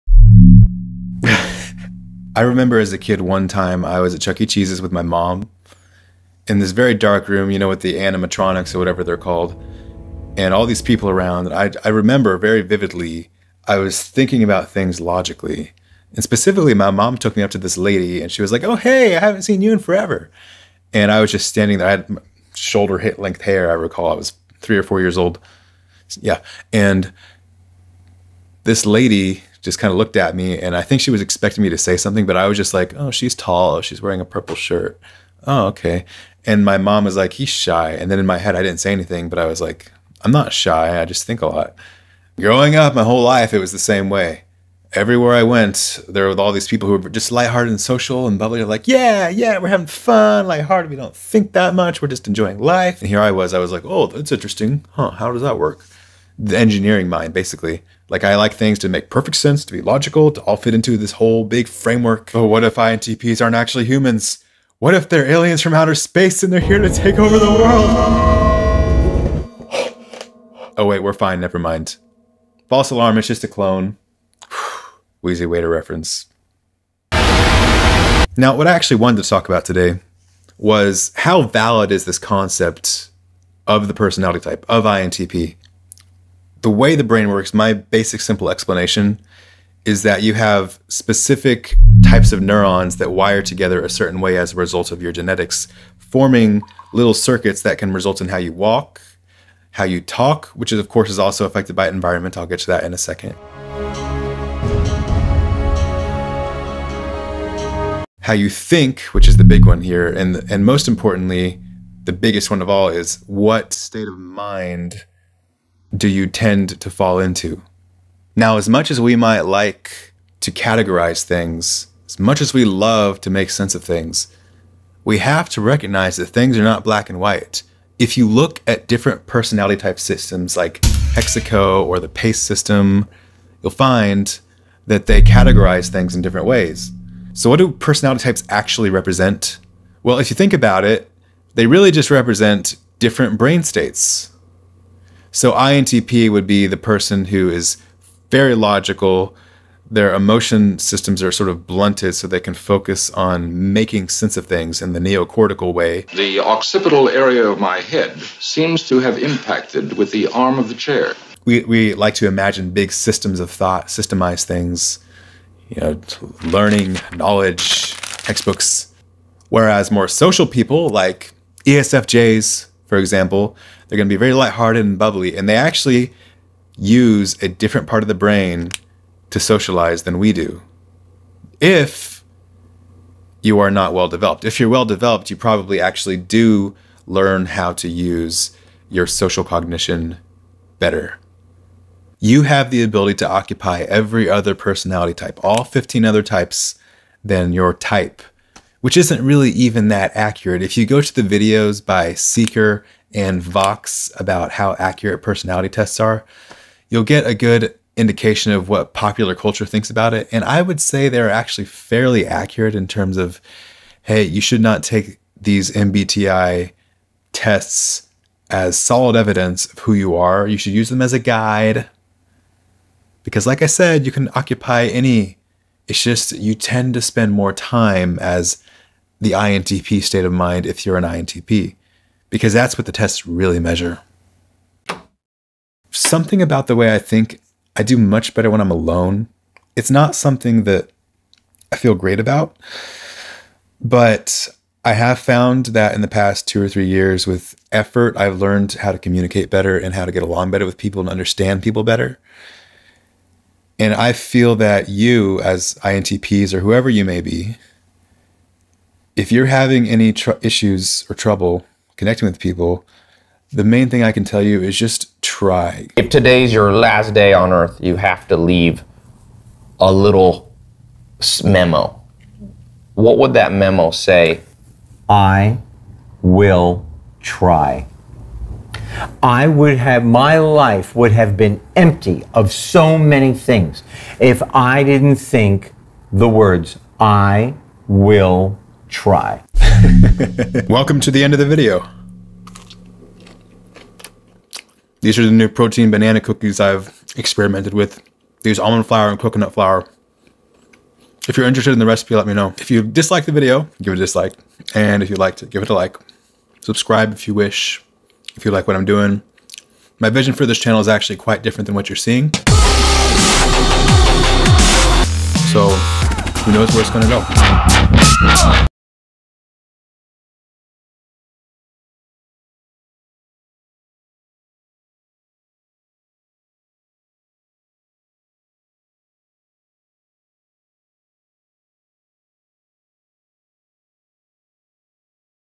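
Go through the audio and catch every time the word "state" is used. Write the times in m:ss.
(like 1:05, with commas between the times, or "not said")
1:53, 2:23, 3:50.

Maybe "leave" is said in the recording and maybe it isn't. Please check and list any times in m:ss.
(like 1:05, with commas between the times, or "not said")
4:28.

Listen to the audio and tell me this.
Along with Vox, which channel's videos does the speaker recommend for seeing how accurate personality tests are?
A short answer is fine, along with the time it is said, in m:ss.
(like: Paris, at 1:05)
Seeker, at 3:22.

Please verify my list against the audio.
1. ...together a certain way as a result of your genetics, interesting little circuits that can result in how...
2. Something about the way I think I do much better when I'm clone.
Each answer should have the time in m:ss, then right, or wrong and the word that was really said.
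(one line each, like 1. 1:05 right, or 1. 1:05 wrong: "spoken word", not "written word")
1. 1:33 wrong: "forming", not "interesting"
2. 3:55 wrong: "alone", not "clone".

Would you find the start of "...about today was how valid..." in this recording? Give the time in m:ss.
1:19.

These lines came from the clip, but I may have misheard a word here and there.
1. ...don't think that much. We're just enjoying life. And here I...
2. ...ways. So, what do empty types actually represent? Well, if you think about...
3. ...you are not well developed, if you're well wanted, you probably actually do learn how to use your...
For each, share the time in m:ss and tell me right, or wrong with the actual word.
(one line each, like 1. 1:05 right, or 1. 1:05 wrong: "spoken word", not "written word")
1. 0:50 right
2. 2:16 wrong: "personality", not "empty"
3. 3:03 wrong: "developed", not "wanted".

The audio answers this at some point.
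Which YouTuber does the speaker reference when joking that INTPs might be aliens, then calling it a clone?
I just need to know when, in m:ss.
1:15.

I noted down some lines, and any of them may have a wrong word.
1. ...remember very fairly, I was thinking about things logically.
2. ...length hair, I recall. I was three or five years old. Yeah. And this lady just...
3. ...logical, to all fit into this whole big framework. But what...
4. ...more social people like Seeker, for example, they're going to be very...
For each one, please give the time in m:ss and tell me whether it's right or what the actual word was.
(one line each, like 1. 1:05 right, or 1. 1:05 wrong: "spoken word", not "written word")
1. 0:11 wrong: "vividly", not "fairly"
2. 0:23 wrong: "four", not "five"
3. 0:59 right
4. 2:49 wrong: "ESFJs", not "Seeker".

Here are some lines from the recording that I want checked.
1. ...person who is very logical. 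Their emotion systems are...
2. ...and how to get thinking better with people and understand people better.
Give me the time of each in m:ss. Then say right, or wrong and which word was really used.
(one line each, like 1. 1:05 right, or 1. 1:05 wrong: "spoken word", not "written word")
1. 2:26 right
2. 4:09 wrong: "along", not "thinking".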